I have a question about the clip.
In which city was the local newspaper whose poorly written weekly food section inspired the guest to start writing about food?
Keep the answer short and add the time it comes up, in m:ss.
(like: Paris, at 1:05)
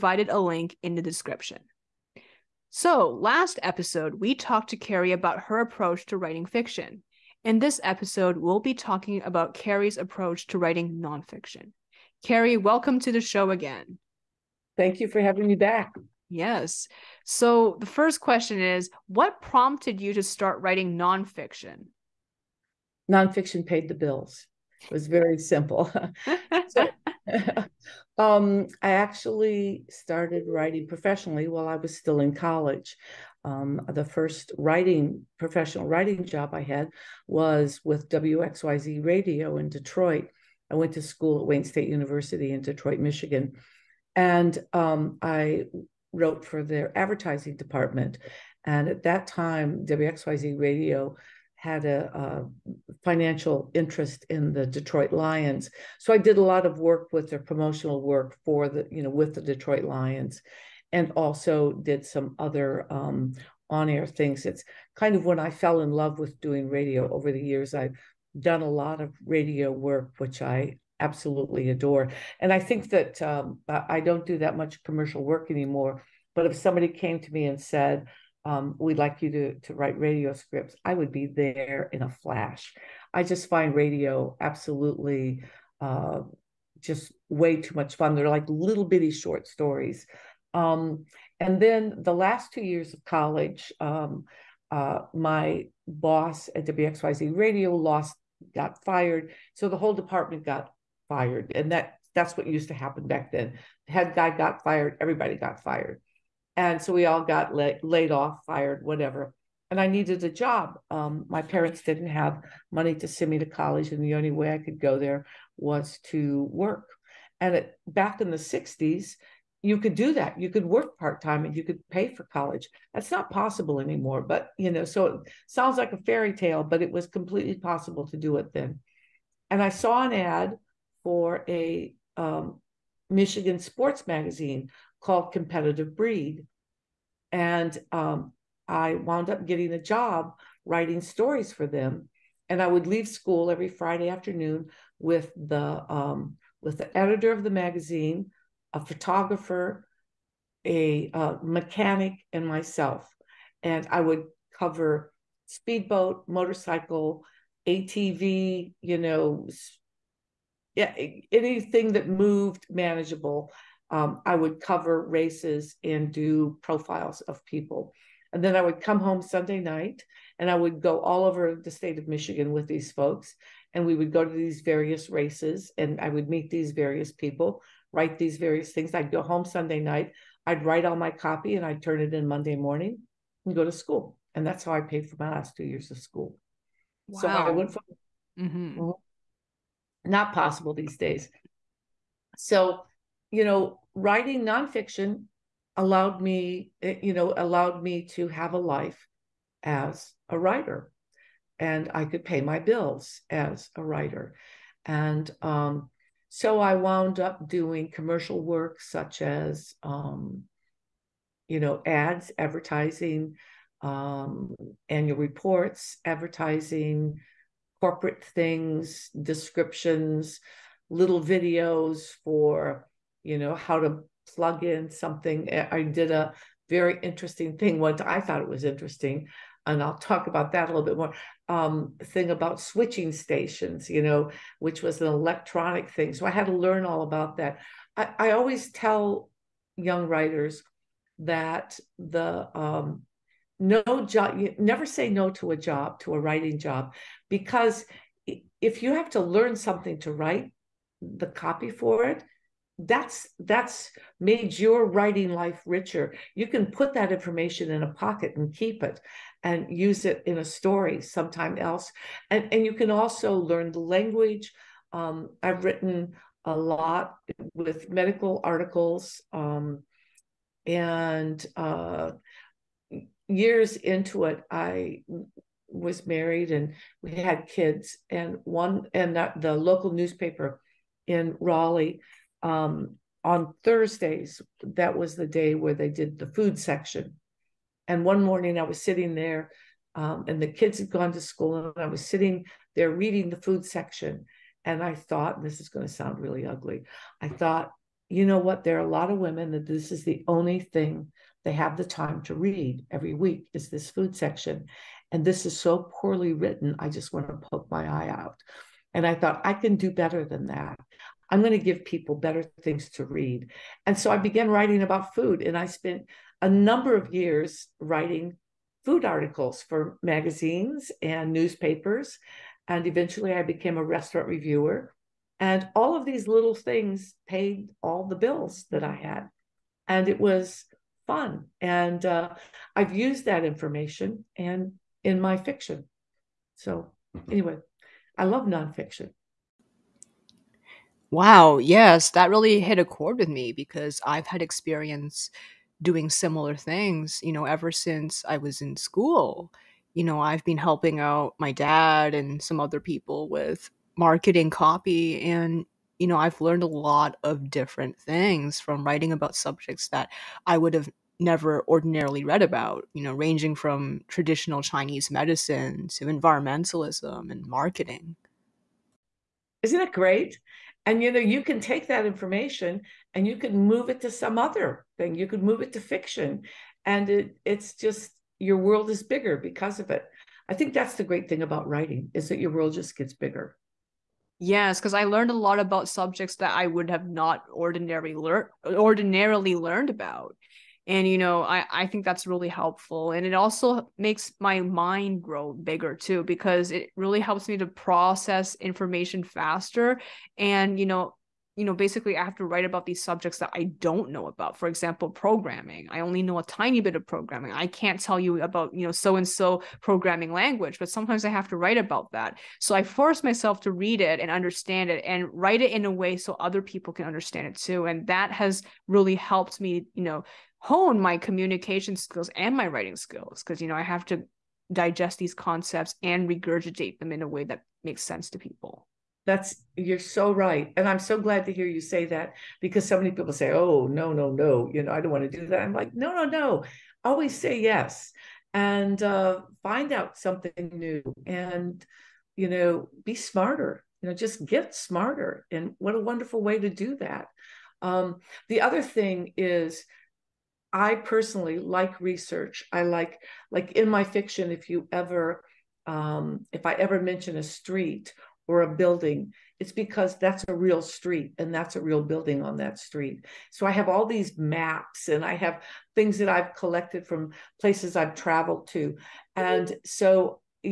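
Raleigh, at 4:41.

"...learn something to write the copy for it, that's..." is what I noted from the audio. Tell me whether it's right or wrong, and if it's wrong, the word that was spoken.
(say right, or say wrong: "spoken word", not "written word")
right.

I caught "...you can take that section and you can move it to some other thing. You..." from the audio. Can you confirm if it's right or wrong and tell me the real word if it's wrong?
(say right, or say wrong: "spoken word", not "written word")
wrong: "information", not "section".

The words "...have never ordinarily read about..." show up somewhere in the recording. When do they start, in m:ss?
6:00.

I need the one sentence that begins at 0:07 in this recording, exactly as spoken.
In this episode, we'll be talking about Carrie's approach to writing nonfiction.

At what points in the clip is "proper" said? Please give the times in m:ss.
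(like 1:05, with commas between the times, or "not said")
not said.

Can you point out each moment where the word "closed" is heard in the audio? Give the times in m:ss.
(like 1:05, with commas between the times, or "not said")
not said.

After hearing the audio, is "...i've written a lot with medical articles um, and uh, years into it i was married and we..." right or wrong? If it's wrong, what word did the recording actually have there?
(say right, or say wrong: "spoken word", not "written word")
right.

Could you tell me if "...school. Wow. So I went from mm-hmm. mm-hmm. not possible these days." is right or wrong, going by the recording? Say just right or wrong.
right.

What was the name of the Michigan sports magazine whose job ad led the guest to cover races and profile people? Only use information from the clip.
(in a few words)
Competitive Breed.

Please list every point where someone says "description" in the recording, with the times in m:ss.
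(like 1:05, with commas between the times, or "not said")
0:01, 3:39.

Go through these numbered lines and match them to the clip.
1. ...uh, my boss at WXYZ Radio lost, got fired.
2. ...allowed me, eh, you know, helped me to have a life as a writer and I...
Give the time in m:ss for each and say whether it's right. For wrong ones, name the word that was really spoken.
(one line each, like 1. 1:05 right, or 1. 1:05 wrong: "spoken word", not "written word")
1. 1:34 right
2. 3:15 wrong: "allowed", not "helped".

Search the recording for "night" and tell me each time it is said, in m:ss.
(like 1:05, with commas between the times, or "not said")
2:49, 2:59.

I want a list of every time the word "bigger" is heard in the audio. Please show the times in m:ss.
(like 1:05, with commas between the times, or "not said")
6:19, 6:23, 6:35.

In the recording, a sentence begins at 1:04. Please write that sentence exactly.
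It's kind of when I fell in love with doing radio over the years.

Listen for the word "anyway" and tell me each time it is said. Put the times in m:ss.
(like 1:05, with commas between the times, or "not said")
5:37.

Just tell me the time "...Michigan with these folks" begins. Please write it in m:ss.
2:52.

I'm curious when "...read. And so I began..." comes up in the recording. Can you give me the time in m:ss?
5:13.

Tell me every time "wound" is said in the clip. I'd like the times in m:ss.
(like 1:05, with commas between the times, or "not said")
2:18, 3:26.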